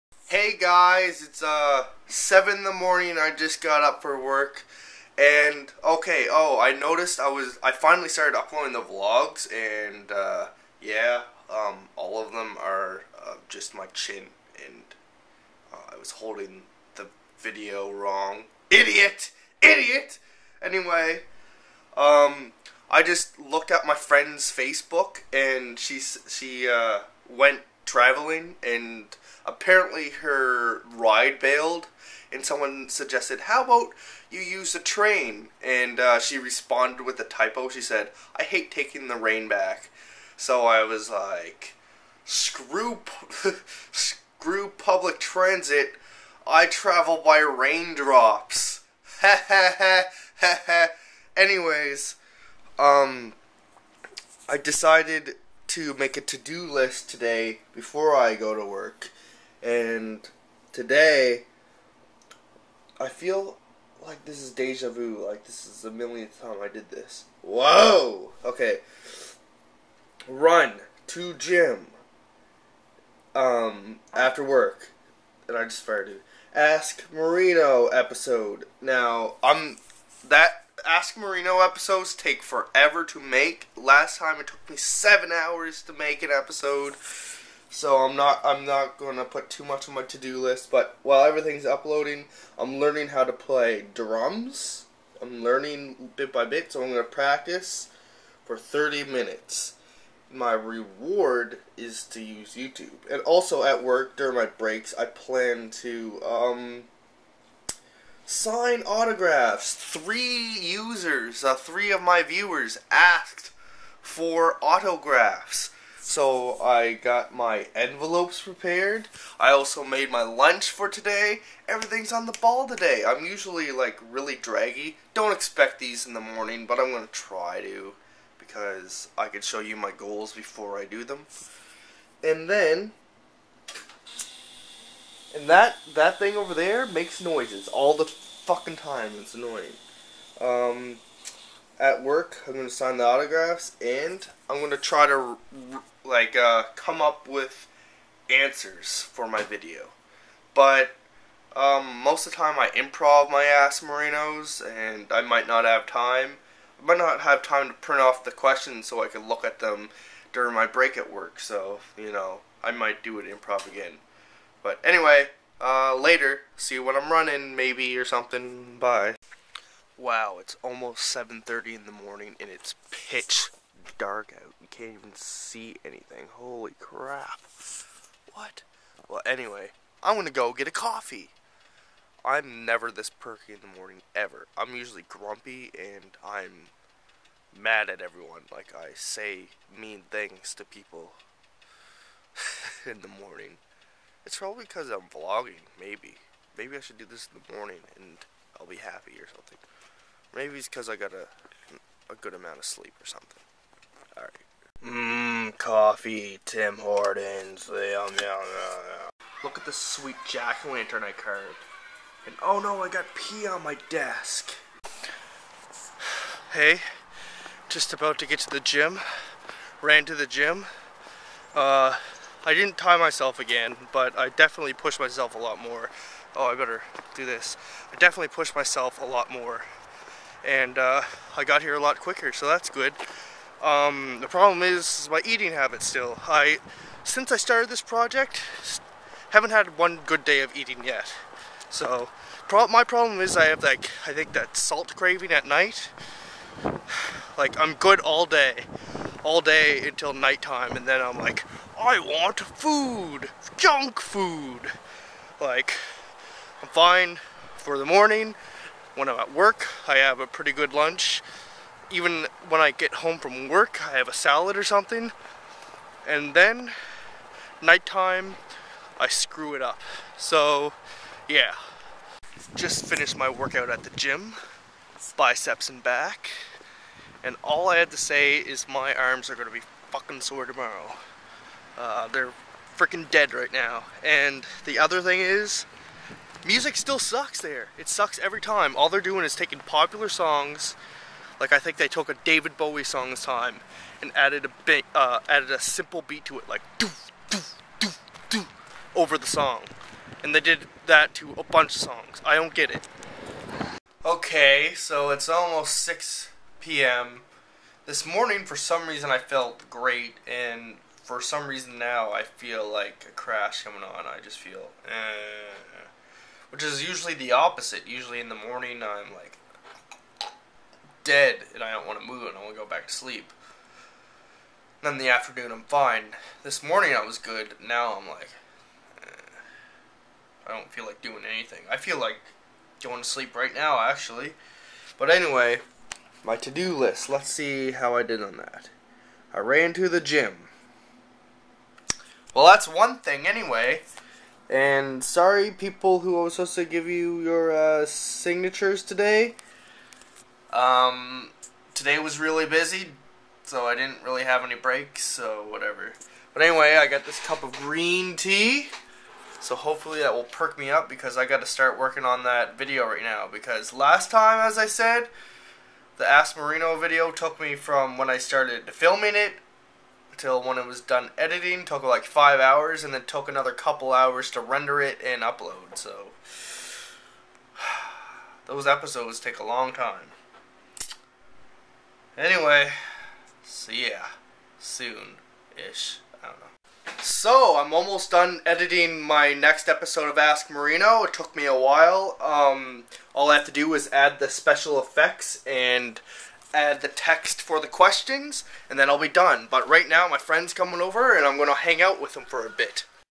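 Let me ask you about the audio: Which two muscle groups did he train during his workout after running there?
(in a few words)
biceps and back.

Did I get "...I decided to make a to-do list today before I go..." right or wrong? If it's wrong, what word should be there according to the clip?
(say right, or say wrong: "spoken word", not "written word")
right.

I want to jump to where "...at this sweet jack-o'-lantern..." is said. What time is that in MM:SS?
03:29.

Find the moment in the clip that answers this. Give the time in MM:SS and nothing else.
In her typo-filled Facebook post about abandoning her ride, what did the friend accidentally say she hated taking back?
00:39.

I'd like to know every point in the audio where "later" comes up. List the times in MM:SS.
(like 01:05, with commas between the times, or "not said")
02:45.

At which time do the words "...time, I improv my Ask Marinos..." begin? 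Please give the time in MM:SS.
02:32.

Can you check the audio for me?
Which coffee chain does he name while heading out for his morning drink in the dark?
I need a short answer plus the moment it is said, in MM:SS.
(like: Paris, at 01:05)
Tim Hortons, at 03:26.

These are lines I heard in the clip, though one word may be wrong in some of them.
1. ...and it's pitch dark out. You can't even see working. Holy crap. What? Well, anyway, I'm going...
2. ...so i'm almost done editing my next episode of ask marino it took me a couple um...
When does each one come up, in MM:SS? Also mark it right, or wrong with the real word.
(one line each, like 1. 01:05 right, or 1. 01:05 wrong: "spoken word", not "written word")
1. 02:52 wrong: "anything", not "working"
2. 06:27 wrong: "while", not "couple".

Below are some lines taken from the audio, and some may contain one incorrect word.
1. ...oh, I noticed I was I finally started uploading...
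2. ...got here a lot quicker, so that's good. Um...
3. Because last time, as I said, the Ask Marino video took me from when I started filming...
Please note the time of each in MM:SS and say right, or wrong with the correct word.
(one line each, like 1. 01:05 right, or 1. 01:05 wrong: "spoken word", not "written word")
1. 00:06 right
2. 03:51 right
3. 06:03 right.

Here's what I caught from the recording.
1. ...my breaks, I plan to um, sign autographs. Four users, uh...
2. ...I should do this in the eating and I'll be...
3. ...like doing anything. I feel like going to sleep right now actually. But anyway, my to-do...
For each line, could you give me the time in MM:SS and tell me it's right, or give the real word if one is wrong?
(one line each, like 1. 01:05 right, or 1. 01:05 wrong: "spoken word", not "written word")
1. 01:44 wrong: "Three", not "Four"
2. 03:16 wrong: "morning", not "eating"
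3. 05:30 right.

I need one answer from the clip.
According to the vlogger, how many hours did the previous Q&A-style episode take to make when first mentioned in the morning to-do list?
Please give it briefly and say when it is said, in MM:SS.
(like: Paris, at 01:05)
7, at 01:24.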